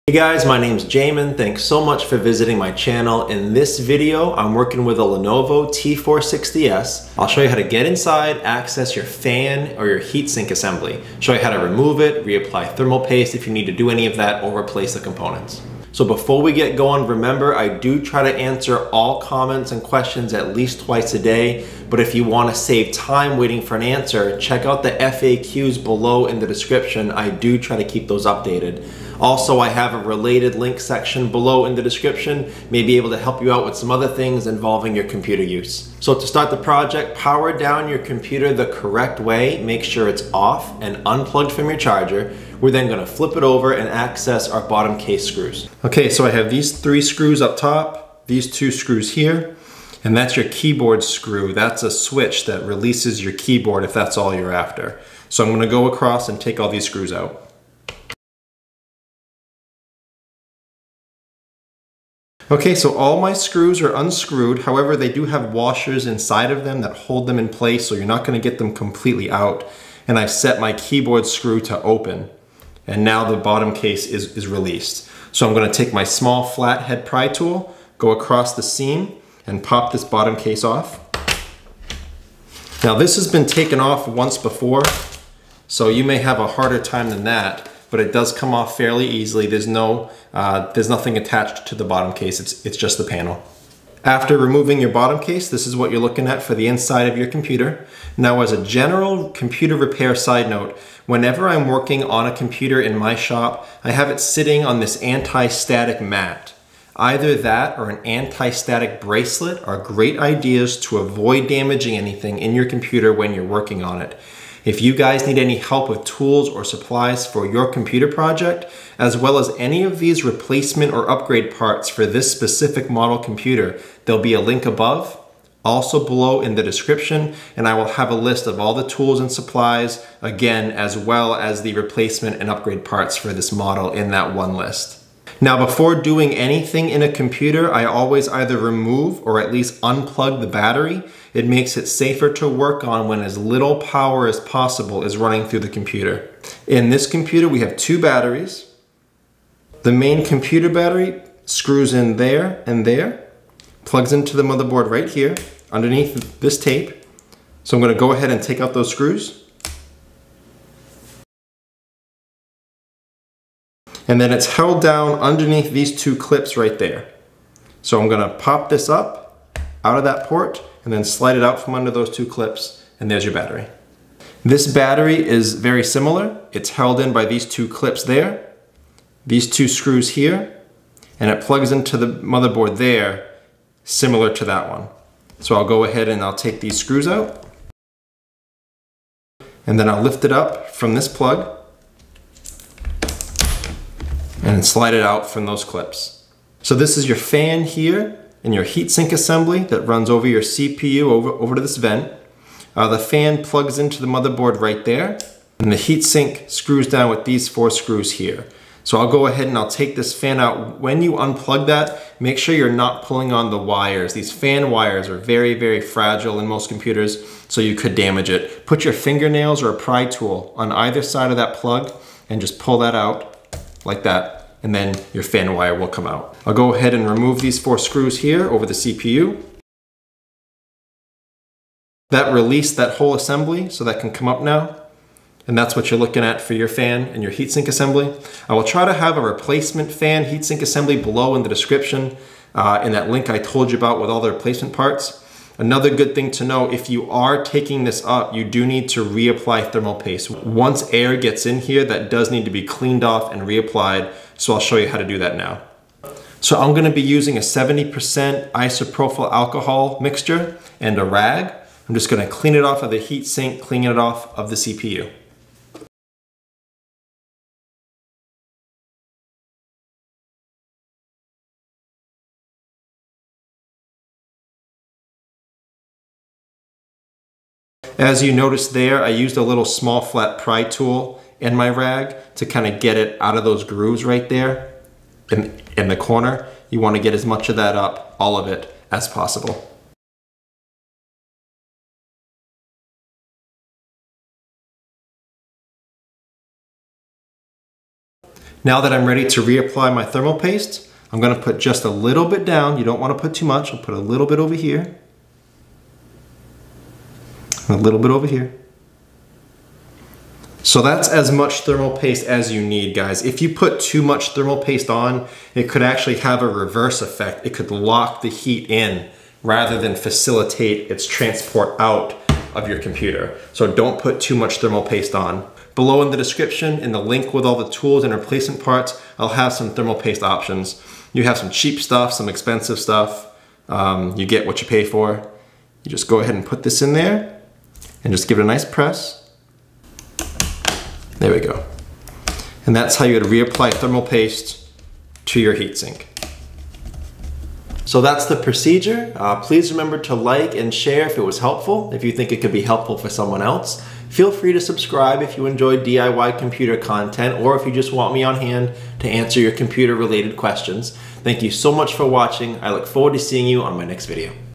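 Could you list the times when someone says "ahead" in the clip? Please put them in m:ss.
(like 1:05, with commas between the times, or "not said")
2:38, 3:05, 3:29, 3:46, 5:36.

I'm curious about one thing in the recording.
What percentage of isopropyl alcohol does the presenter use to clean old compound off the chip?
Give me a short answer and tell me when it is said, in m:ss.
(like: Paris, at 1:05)
70%, at 4:17.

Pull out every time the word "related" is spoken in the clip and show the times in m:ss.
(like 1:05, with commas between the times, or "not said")
0:30, 5:59.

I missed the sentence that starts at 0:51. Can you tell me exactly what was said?
That's a switch that releases your keyboard if that's all you're after.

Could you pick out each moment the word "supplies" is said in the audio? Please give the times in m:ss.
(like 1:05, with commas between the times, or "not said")
1:56, 2:09.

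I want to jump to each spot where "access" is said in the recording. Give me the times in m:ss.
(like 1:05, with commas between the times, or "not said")
0:08, 0:43.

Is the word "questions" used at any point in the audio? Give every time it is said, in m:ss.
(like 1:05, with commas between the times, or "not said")
0:19, 6:00.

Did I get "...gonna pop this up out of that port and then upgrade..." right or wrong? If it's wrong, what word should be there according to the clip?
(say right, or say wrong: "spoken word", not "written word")
wrong: "slide", not "upgrade".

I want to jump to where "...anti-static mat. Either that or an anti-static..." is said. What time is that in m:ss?
1:45.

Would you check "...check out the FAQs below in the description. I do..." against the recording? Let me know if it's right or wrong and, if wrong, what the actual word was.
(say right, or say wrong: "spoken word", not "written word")
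right.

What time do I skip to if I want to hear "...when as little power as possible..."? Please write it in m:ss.
2:23.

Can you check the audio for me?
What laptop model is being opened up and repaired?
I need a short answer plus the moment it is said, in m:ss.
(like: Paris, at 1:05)
Lenovo T460S, at 0:05.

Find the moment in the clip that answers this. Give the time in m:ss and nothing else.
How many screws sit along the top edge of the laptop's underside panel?
0:46.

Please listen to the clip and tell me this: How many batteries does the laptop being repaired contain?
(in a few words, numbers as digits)
2.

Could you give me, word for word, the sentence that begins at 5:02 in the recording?
You don't wanna put too much.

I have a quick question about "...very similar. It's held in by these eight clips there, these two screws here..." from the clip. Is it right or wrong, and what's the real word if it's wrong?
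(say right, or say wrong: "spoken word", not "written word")
wrong: "two", not "eight".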